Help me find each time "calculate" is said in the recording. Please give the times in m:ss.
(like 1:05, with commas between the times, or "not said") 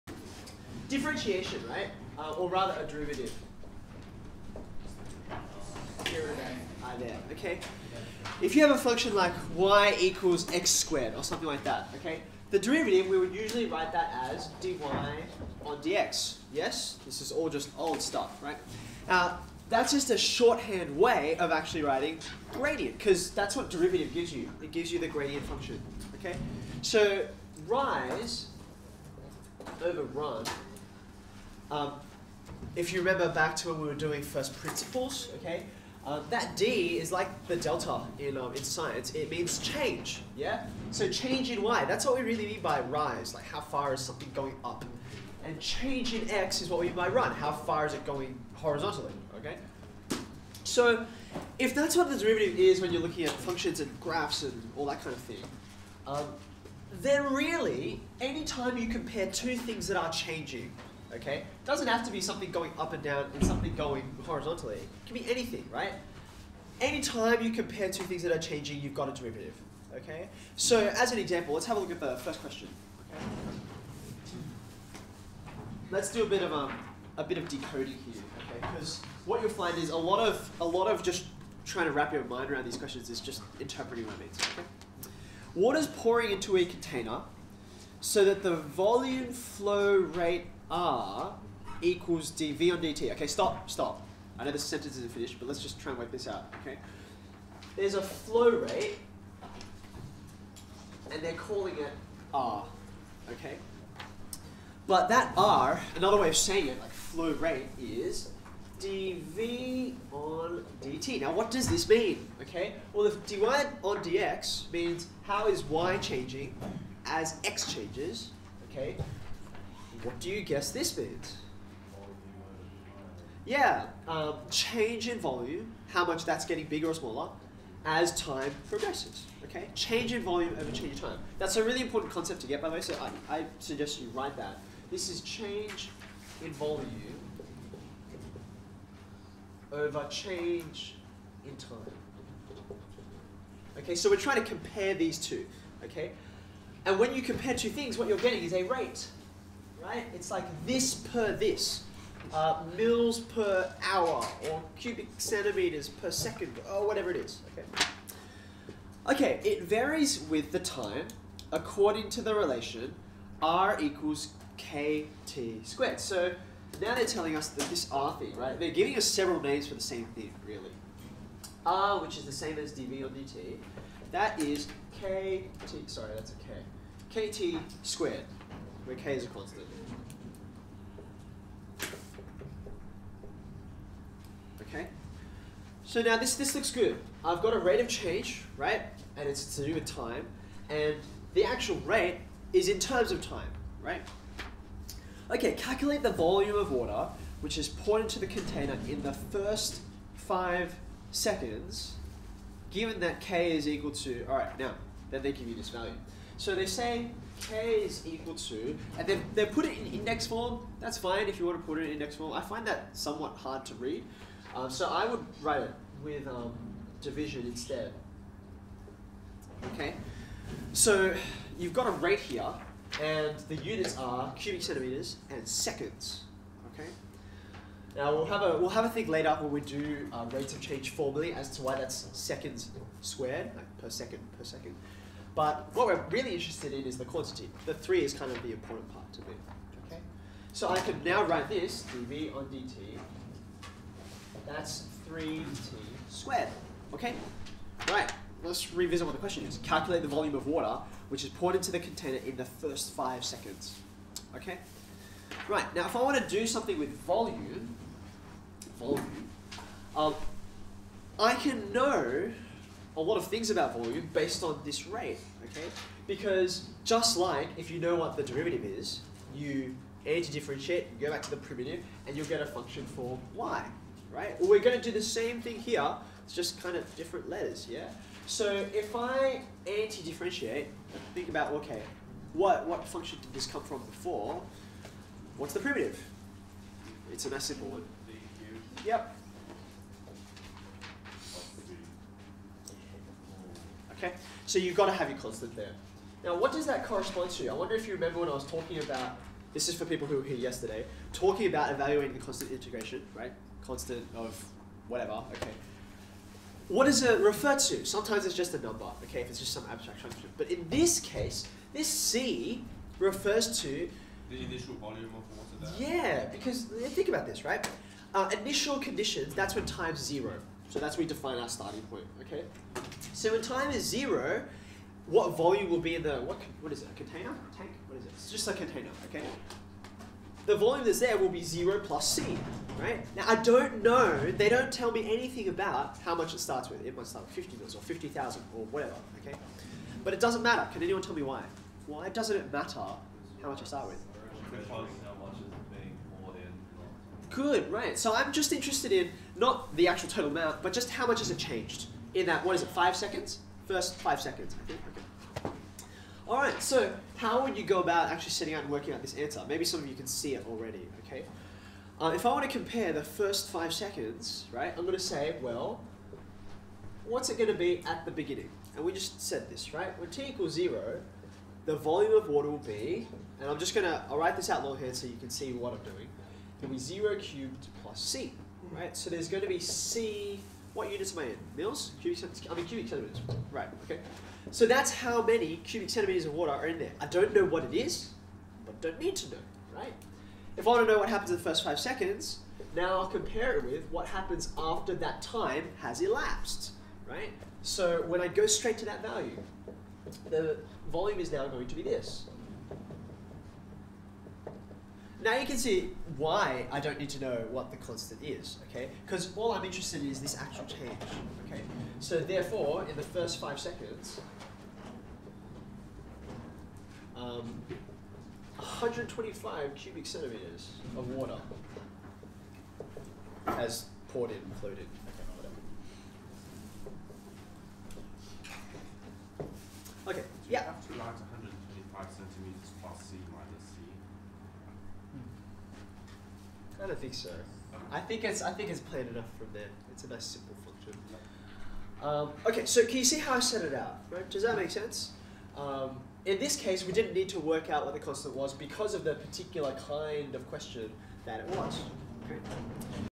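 3:15, 4:09.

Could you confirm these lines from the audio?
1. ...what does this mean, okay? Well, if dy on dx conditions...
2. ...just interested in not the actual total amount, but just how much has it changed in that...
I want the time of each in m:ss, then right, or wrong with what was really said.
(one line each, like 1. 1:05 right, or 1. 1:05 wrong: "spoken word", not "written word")
1. 1:51 wrong: "means", not "conditions"
2. 5:48 right.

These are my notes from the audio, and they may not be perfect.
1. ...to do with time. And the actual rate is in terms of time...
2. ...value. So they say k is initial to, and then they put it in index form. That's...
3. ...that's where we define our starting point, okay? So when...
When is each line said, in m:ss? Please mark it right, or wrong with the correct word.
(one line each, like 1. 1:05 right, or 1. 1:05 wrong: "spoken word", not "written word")
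1. 3:09 right
2. 3:25 wrong: "equal", not "initial"
3. 5:20 right.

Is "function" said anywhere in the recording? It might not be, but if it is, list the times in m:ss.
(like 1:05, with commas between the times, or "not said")
0:08, 0:25, 0:53, 4:32, 4:42, 5:10, 7:20.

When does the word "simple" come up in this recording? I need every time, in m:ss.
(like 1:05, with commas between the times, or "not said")
4:47, 7:20.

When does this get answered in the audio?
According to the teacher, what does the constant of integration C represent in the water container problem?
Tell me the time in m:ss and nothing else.
5:14.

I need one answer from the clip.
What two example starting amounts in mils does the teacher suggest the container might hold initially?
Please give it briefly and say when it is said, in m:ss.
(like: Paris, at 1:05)
50 or 50,000, at 5:37.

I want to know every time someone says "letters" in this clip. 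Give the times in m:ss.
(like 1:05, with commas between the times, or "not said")
4:37.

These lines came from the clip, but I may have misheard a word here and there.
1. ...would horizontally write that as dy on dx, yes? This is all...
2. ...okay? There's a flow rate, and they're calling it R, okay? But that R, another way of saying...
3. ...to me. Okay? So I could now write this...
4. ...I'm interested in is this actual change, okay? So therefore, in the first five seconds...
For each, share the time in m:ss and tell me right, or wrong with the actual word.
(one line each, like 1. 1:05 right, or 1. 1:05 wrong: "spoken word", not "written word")
1. 0:13 wrong: "usually", not "horizontally"
2. 1:36 right
3. 3:59 right
4. 6:49 right.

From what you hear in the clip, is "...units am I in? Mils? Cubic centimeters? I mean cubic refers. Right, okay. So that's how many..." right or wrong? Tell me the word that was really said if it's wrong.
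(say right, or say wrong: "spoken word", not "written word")
wrong: "centimeters", not "refers".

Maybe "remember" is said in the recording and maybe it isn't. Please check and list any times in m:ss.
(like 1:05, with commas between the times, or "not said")
0:32, 4:57.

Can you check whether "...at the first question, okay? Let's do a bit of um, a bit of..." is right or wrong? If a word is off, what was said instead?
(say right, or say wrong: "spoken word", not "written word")
right.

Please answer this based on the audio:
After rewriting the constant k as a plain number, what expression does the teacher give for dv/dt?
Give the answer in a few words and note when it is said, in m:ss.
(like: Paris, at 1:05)
3t squared, at 4:05.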